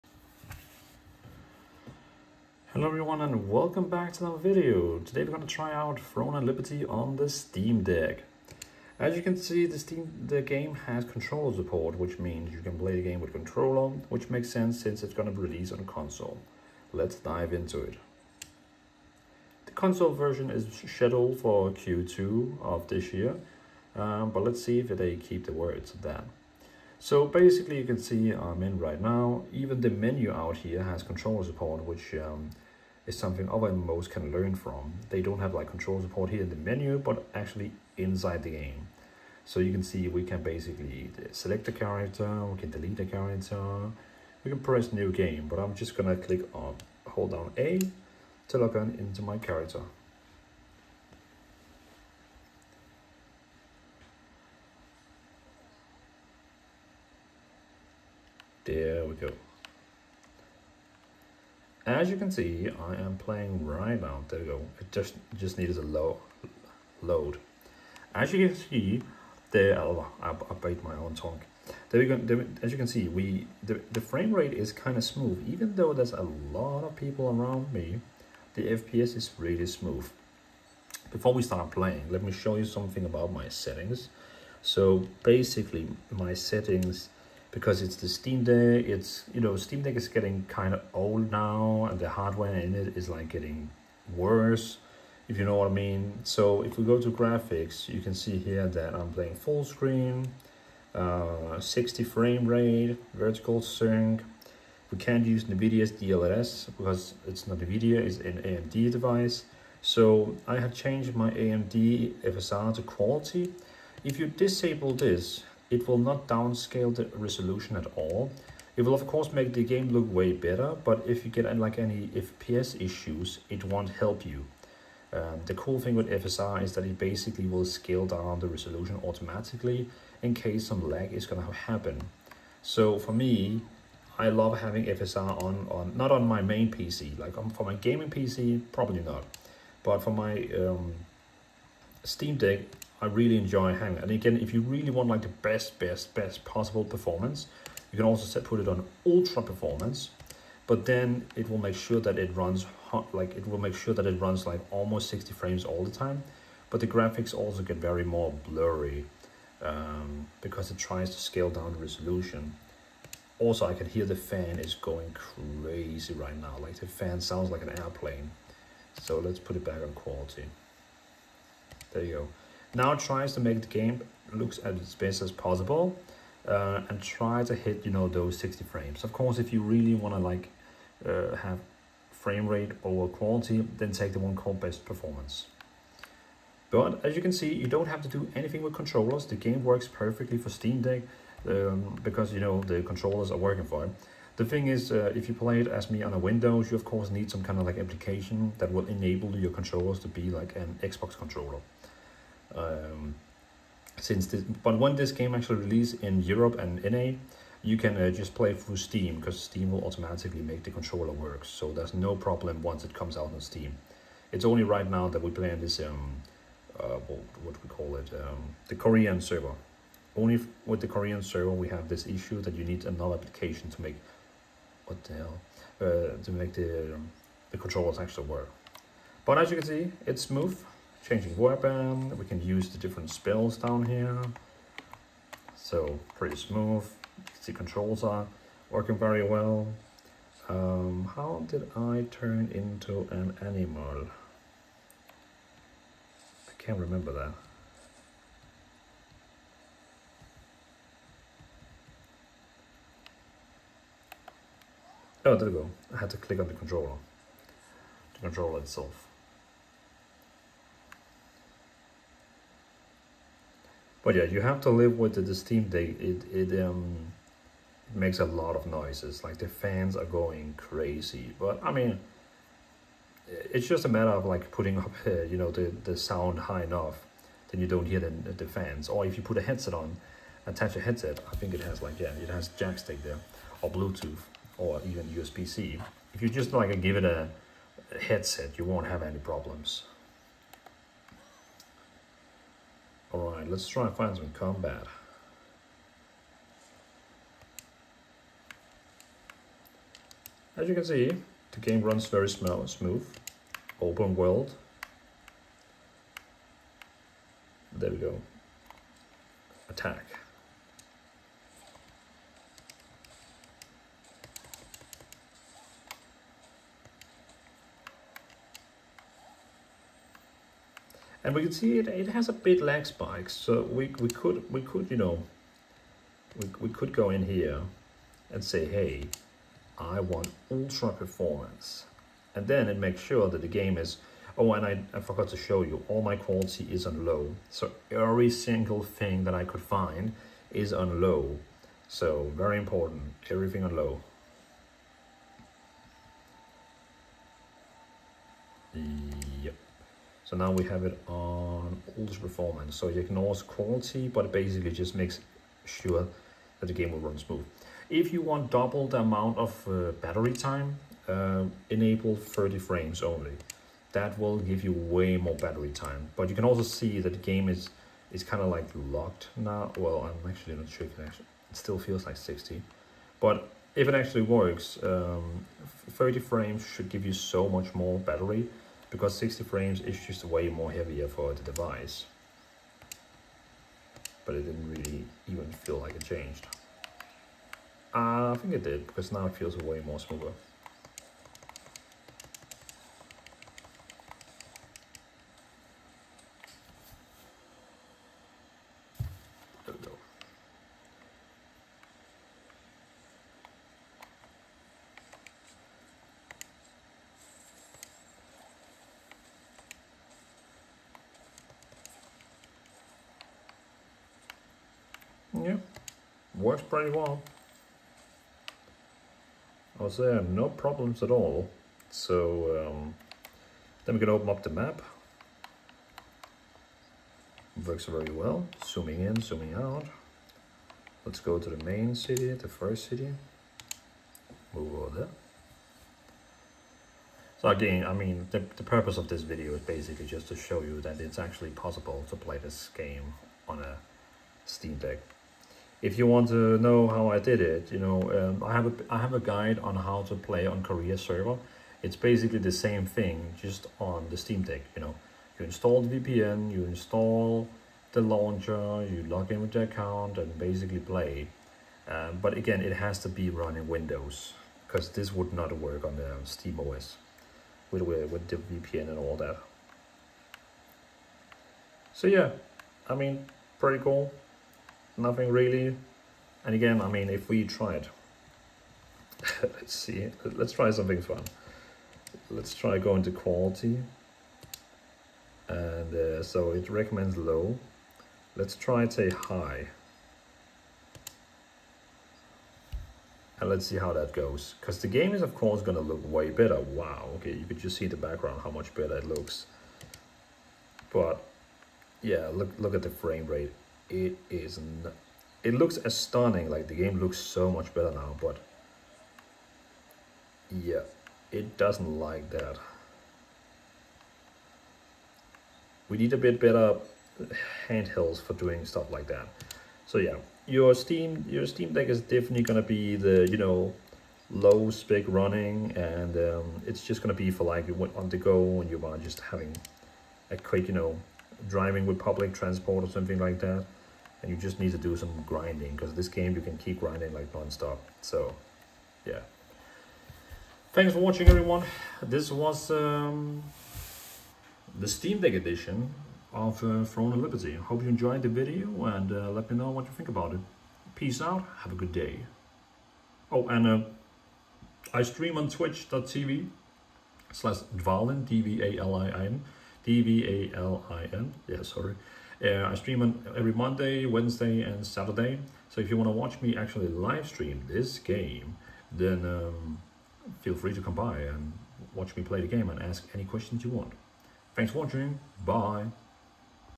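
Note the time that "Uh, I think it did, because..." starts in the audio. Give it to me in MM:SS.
06:27.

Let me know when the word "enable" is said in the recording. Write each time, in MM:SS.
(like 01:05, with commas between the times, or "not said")
03:18, 06:01.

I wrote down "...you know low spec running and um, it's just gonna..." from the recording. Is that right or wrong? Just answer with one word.
right.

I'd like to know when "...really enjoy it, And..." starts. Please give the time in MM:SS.
02:23.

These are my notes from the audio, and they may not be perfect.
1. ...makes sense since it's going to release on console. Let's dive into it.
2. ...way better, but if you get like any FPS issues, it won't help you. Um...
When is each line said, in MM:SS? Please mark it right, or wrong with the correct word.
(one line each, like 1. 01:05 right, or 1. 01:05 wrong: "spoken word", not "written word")
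1. 00:14 right
2. 02:00 right.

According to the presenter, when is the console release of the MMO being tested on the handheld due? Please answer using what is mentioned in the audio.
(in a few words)
Q2 of this year.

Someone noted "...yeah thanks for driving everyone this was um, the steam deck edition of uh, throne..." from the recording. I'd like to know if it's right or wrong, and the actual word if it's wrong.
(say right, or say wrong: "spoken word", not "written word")
wrong: "watching", not "driving".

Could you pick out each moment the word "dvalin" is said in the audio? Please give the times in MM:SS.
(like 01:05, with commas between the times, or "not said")
09:17.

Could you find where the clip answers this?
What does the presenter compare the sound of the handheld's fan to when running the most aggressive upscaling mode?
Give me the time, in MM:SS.
02:47.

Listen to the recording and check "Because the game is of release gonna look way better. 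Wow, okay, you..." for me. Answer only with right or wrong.
wrong.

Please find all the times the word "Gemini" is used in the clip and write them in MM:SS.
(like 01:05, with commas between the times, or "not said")
not said.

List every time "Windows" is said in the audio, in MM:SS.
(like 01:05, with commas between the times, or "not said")
03:16, 07:43.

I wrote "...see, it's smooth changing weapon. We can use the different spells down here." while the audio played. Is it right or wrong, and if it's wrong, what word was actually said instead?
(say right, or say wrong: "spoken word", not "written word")
right.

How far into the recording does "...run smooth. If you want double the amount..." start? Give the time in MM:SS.
05:57.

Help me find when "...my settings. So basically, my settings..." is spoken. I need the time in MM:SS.
01:23.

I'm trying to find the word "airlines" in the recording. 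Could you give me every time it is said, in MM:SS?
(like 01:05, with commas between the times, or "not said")
not said.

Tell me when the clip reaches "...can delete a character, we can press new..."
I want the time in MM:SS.
00:42.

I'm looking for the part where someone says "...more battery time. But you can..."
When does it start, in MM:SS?
06:05.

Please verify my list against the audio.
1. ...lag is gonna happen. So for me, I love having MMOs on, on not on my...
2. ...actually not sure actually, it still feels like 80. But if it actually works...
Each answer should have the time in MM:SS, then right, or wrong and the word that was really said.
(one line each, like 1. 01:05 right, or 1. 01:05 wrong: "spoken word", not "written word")
1. 02:10 wrong: "FSR", not "MMOs"
2. 06:10 wrong: "60", not "80".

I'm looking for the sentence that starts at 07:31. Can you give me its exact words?
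It's basically the same thing, just on the Steam Deck.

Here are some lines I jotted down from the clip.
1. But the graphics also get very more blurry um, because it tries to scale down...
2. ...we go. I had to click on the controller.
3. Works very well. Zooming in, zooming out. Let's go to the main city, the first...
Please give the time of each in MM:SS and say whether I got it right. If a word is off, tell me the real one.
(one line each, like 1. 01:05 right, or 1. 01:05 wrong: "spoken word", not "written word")
1. 02:36 right
2. 04:15 right
3. 07:07 right.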